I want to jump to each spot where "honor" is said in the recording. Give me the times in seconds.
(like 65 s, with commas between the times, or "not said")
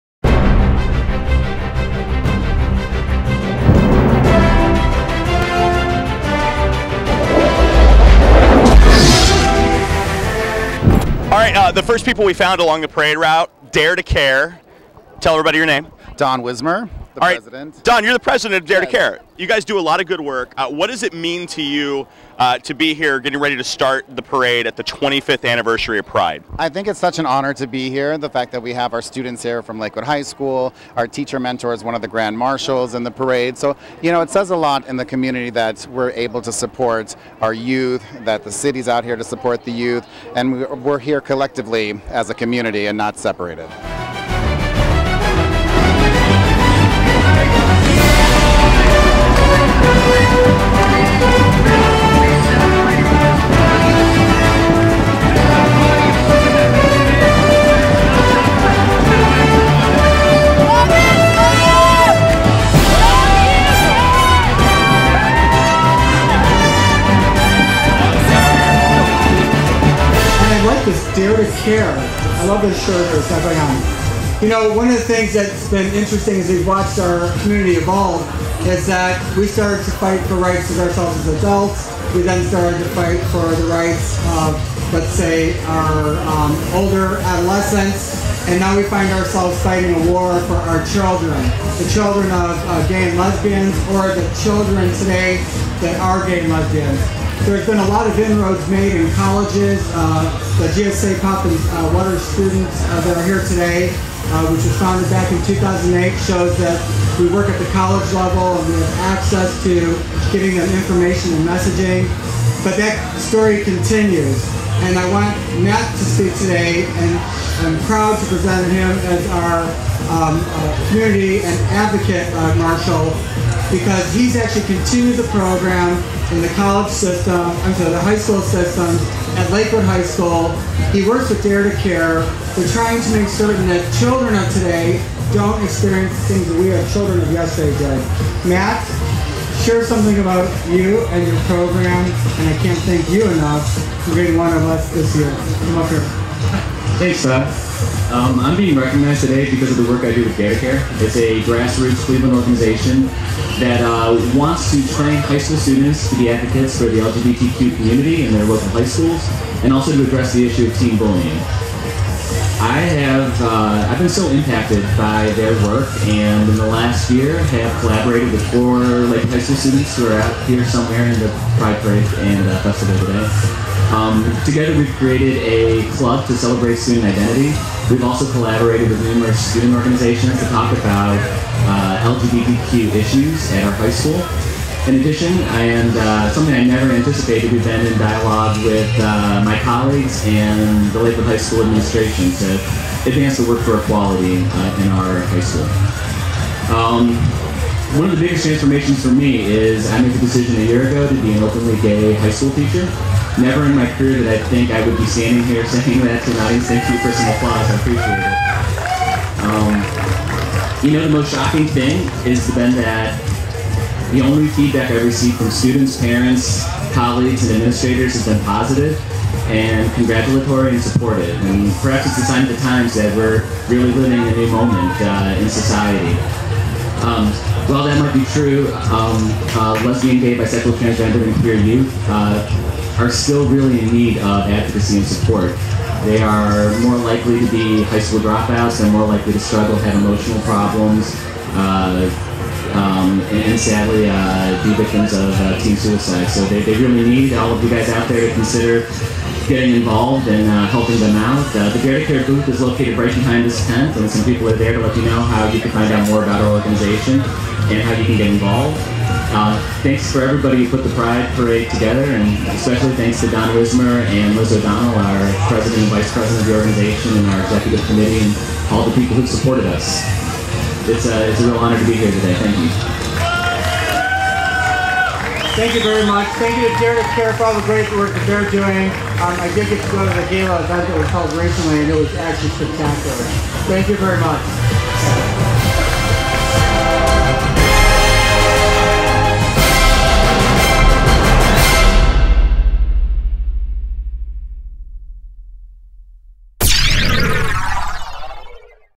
27 s, 271 s.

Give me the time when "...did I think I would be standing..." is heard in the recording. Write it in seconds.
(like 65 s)
204 s.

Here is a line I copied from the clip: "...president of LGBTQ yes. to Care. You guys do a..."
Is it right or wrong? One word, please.
wrong.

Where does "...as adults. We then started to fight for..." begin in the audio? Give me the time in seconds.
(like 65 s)
81 s.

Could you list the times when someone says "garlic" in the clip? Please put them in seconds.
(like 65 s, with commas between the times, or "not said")
not said.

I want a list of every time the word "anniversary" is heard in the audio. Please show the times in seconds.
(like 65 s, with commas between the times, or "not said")
25 s.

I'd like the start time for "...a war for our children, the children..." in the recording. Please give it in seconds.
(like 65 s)
89 s.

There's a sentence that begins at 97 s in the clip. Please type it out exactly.
There's been a lot of inroads made in colleges.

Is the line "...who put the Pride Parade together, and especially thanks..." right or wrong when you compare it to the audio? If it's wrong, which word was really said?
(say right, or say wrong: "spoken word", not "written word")
right.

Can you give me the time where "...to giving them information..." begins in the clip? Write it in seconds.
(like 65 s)
109 s.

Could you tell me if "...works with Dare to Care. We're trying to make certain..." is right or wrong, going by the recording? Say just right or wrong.
right.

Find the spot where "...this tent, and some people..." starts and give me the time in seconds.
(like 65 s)
253 s.